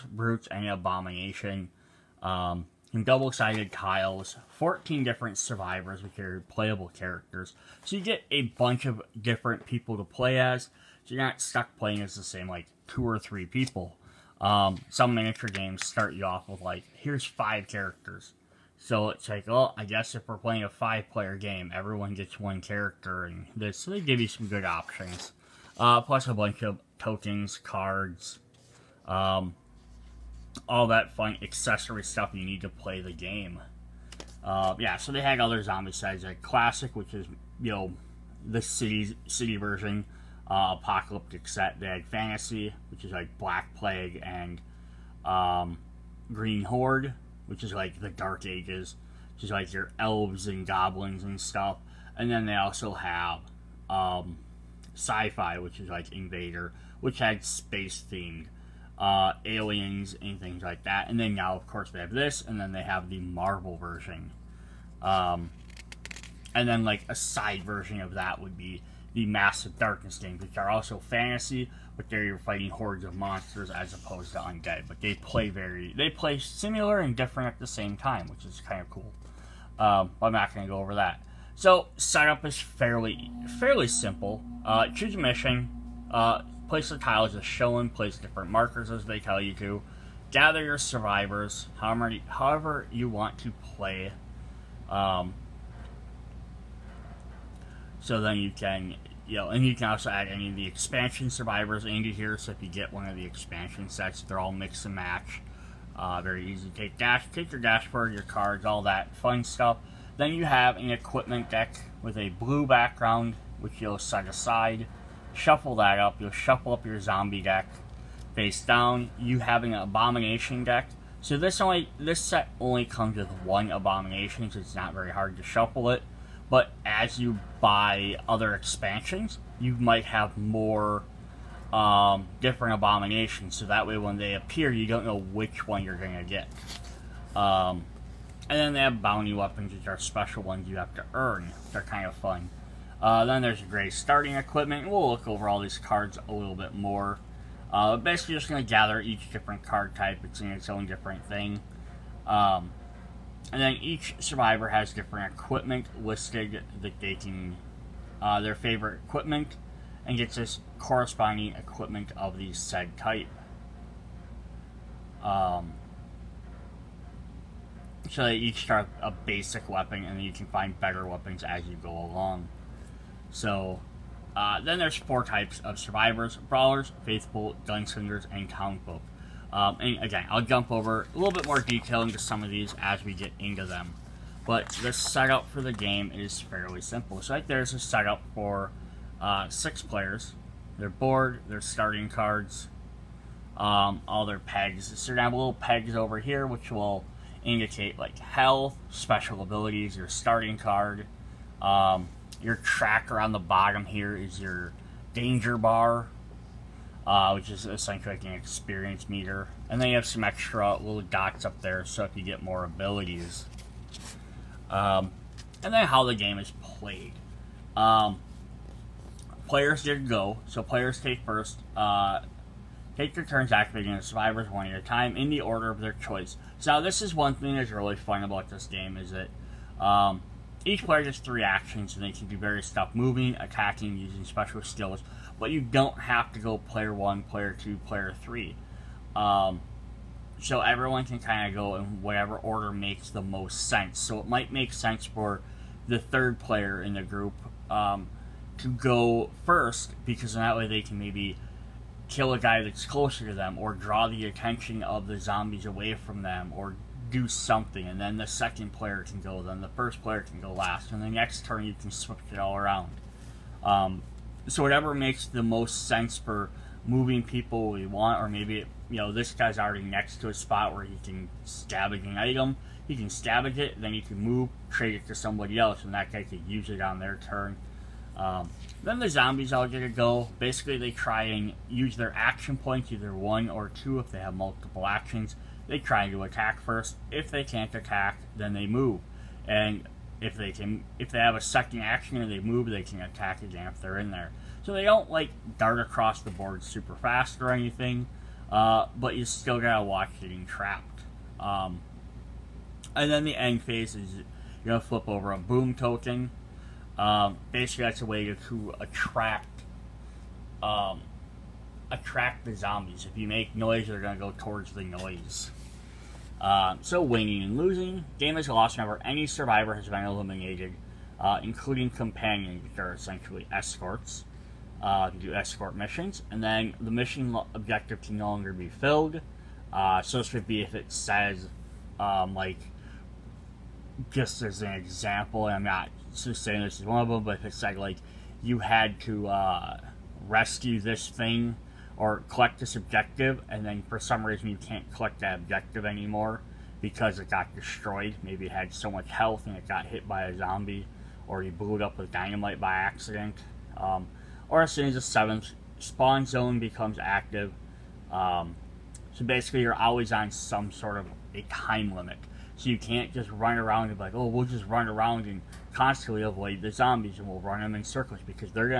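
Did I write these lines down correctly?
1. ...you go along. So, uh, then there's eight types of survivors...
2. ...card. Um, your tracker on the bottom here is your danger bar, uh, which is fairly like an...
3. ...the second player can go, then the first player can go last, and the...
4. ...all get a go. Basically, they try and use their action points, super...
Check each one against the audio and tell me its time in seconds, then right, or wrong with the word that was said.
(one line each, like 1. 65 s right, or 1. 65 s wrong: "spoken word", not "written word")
1. 171 s wrong: "four", not "eight"
2. 200 s wrong: "essentially", not "fairly"
3. 258 s right
4. 279 s wrong: "either", not "super".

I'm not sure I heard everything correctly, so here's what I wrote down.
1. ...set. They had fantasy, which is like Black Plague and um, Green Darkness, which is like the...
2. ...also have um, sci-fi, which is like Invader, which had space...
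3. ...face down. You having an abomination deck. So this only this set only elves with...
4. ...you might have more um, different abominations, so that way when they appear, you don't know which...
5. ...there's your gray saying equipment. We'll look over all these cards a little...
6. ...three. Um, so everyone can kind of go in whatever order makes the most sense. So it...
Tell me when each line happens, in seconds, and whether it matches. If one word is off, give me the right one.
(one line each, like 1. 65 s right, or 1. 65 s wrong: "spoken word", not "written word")
1. 41 s wrong: "Horde", not "Darkness"
2. 52 s right
3. 118 s wrong: "comes", not "elves"
4. 129 s right
5. 143 s wrong: "starting", not "saying"
6. 238 s right.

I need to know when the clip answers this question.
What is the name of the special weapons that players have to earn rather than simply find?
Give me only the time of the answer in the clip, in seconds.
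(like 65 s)
139 s.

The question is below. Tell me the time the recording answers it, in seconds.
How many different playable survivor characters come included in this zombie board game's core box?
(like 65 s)
4 s.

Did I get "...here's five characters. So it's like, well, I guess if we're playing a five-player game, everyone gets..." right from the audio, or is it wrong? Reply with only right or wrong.
right.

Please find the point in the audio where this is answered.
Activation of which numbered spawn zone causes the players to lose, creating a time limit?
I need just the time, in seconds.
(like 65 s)
355 s.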